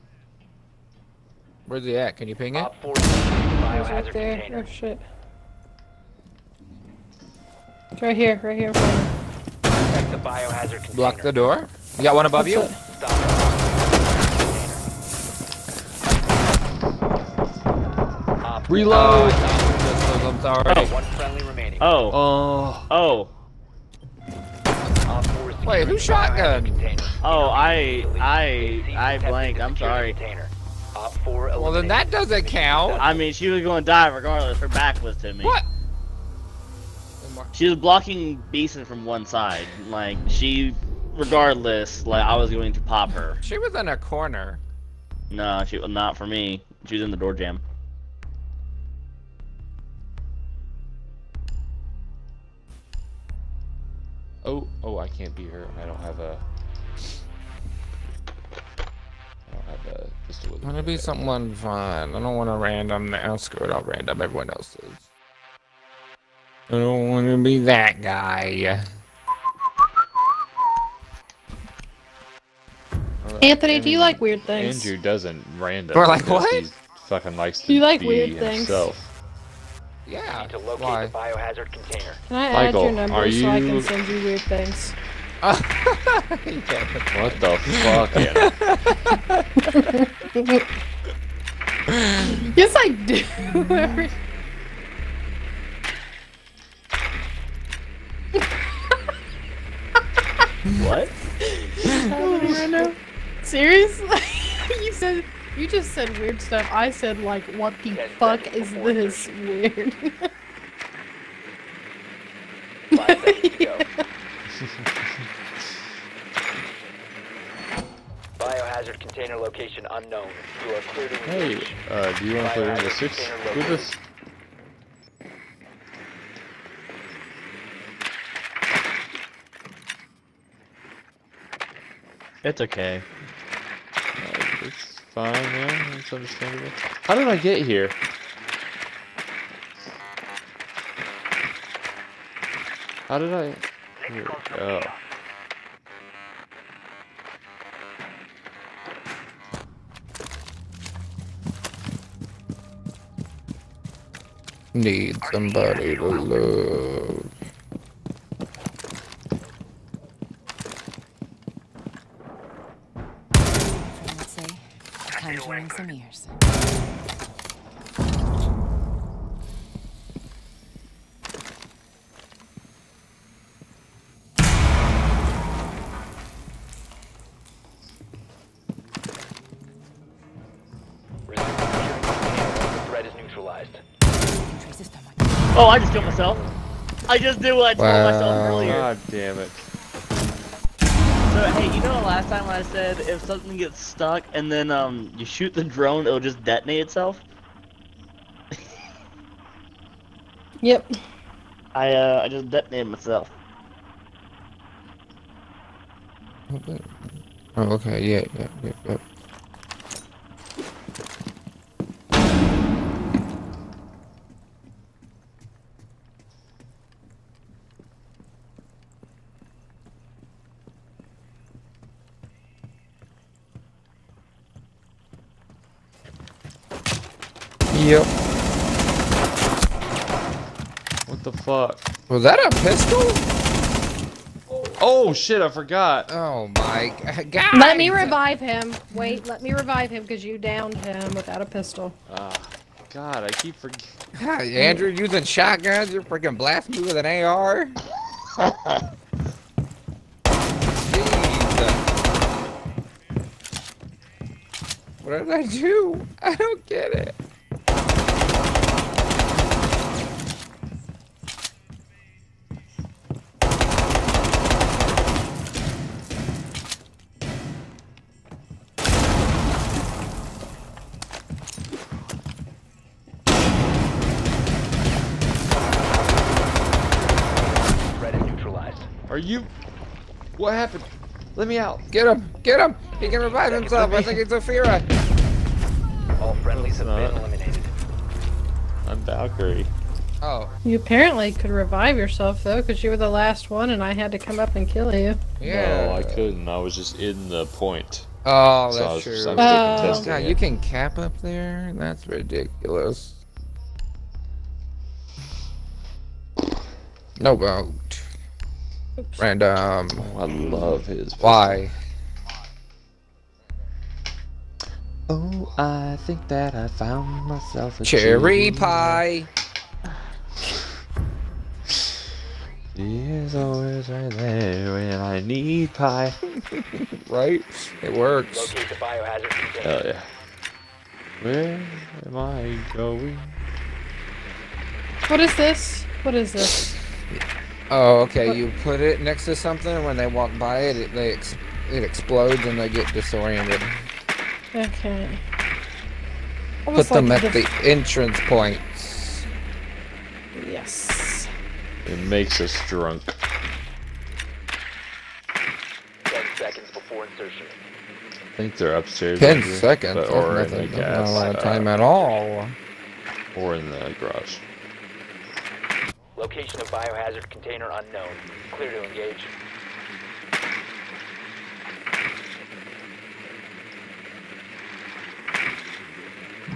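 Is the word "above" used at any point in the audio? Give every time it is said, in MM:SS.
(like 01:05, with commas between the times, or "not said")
00:12.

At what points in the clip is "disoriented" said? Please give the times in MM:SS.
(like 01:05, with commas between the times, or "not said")
05:42.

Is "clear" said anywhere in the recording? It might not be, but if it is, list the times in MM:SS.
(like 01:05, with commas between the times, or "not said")
02:00, 06:08.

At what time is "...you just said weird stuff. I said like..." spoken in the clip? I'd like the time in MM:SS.
01:45.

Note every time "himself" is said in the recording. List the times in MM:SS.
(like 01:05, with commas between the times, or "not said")
01:18, 04:43.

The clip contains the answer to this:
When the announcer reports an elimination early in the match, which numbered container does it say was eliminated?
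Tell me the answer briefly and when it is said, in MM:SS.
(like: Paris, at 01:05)
4, at 00:30.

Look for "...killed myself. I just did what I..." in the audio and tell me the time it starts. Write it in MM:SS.
03:05.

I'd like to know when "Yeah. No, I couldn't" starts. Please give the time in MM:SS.
04:55.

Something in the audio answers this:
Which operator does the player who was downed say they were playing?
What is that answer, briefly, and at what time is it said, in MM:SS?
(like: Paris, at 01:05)
Valkyrie, at 04:48.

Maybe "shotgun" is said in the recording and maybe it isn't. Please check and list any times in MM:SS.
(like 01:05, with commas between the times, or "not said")
00:25, 04:05.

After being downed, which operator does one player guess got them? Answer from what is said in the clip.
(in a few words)
Ophira.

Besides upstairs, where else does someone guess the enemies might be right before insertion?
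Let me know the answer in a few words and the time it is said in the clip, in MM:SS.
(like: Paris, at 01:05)
garage, at 06:03.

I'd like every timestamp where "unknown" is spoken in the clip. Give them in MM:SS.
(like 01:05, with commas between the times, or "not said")
01:59, 06:07.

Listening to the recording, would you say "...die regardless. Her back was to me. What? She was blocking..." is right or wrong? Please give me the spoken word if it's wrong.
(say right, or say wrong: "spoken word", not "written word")
right.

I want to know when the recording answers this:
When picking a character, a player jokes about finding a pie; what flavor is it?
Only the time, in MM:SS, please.
05:17.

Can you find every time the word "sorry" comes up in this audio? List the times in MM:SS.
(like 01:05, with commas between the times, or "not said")
00:20, 00:29.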